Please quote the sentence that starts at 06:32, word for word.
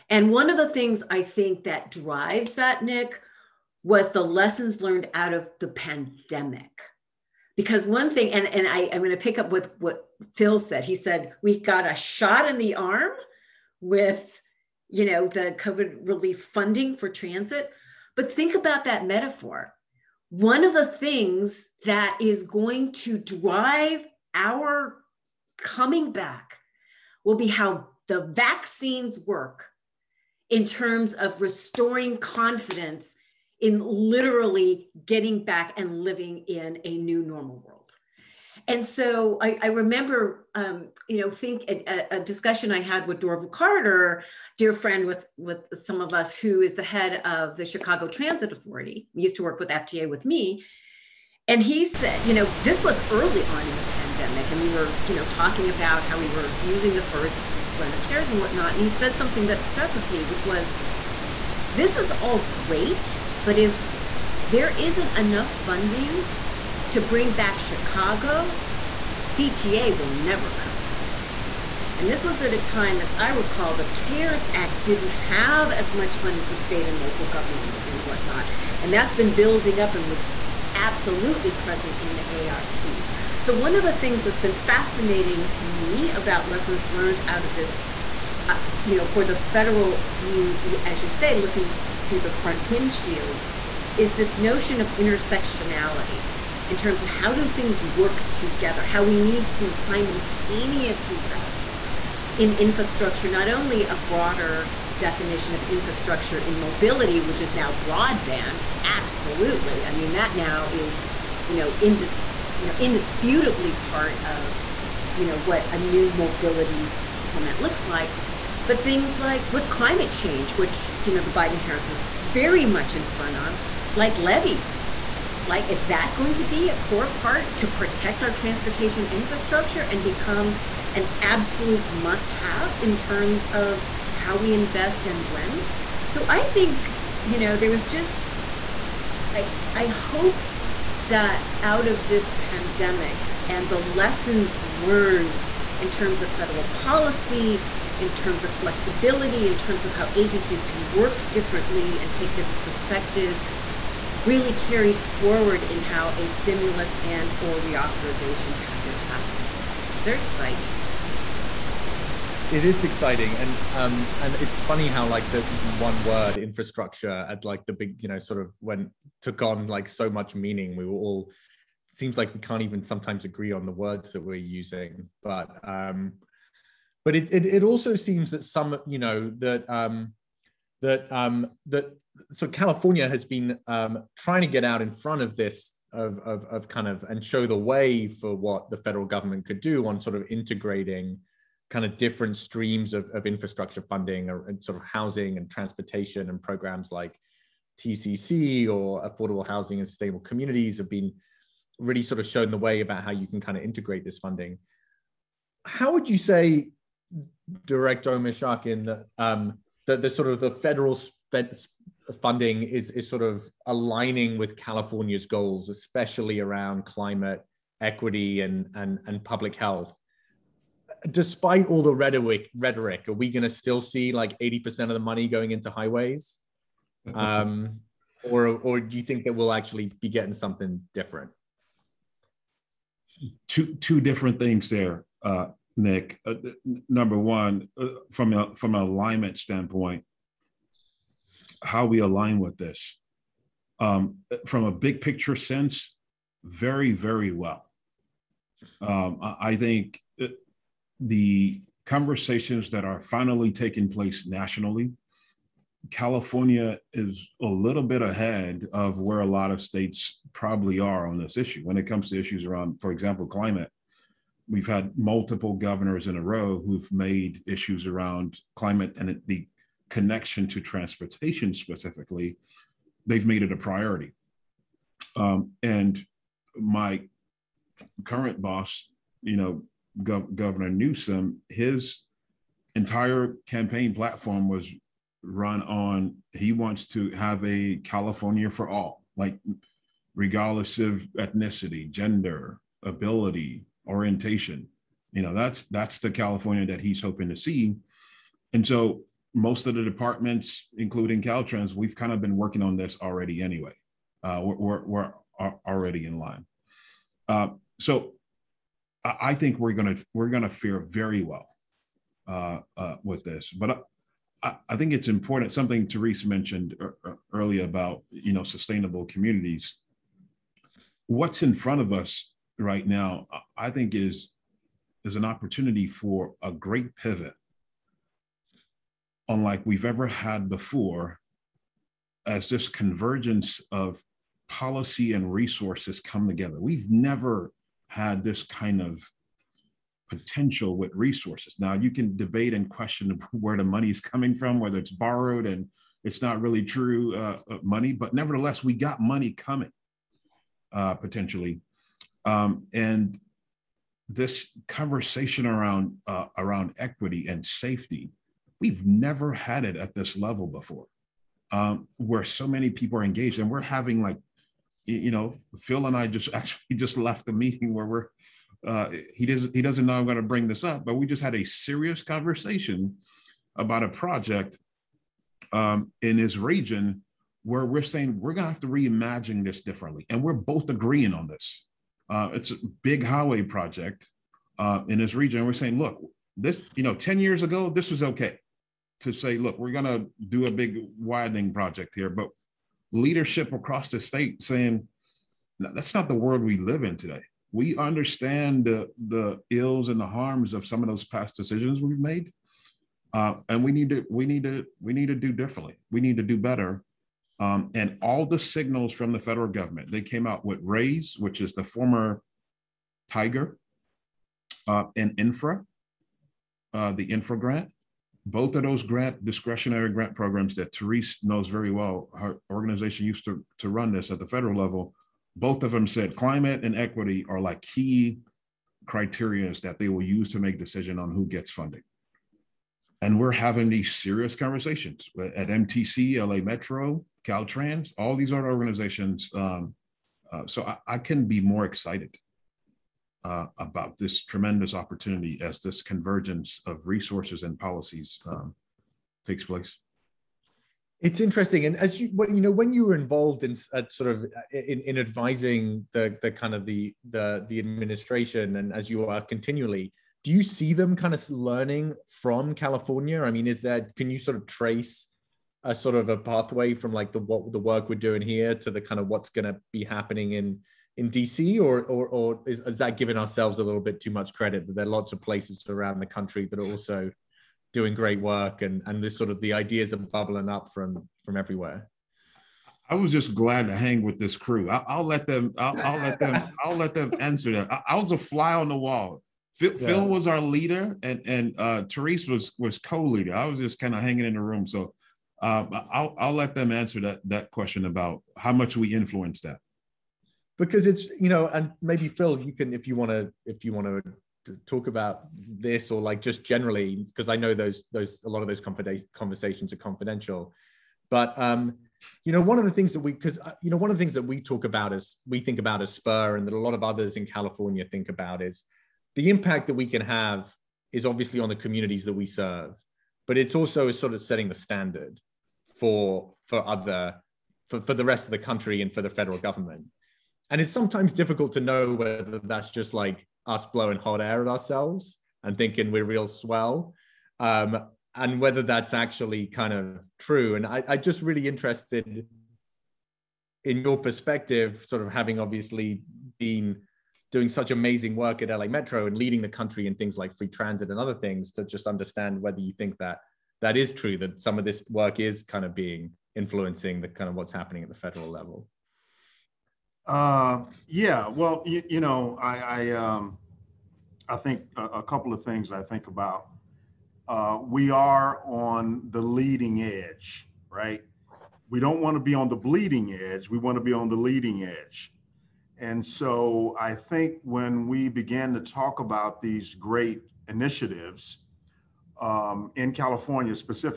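But leadership across the state saying, no, that's not the world we live in today.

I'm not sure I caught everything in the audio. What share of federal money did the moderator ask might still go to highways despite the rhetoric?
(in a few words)
80 percent.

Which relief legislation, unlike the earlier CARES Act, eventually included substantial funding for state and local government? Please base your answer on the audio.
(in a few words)
ARP.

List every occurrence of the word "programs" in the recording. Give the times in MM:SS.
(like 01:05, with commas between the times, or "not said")
03:16, 07:00.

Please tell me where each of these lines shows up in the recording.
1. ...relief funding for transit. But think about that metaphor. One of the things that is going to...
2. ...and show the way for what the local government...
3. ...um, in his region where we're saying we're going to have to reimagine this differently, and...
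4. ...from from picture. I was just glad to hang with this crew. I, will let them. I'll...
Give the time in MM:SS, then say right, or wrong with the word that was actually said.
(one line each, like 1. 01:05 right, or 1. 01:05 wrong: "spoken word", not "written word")
1. 00:16 right
2. 03:07 wrong: "federal", not "local"
3. 06:15 right
4. 08:00 wrong: "everywhere", not "picture".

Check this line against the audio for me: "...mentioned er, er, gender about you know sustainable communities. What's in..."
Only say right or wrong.
wrong.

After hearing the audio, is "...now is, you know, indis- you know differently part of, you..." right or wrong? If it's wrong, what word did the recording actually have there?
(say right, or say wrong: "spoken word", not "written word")
wrong: "indisputably", not "differently".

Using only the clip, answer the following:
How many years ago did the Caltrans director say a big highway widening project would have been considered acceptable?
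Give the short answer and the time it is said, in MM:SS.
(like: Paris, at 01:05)
10, at 06:26.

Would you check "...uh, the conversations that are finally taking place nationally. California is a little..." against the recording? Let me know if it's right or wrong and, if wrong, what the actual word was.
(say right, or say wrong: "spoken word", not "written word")
right.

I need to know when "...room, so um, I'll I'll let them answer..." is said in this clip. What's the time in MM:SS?
08:14.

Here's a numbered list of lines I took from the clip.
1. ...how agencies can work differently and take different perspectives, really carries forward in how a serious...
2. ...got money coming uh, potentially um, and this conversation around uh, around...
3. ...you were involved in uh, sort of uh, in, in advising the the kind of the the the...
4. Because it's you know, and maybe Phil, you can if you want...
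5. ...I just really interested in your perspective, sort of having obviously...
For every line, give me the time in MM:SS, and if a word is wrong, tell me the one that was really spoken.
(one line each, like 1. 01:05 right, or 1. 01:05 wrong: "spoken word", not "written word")
1. 02:29 wrong: "stimulus", not "serious"
2. 05:48 right
3. 07:32 right
4. 08:20 right
5. 09:00 right.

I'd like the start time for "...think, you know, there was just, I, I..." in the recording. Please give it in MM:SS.
02:16.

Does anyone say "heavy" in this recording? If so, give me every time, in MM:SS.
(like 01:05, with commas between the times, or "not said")
not said.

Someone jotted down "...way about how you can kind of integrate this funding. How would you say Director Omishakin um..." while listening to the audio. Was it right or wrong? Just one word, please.
right.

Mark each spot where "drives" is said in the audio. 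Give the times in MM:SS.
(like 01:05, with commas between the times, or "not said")
00:01, 00:23.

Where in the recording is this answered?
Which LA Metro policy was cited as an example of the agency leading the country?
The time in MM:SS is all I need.
09:10.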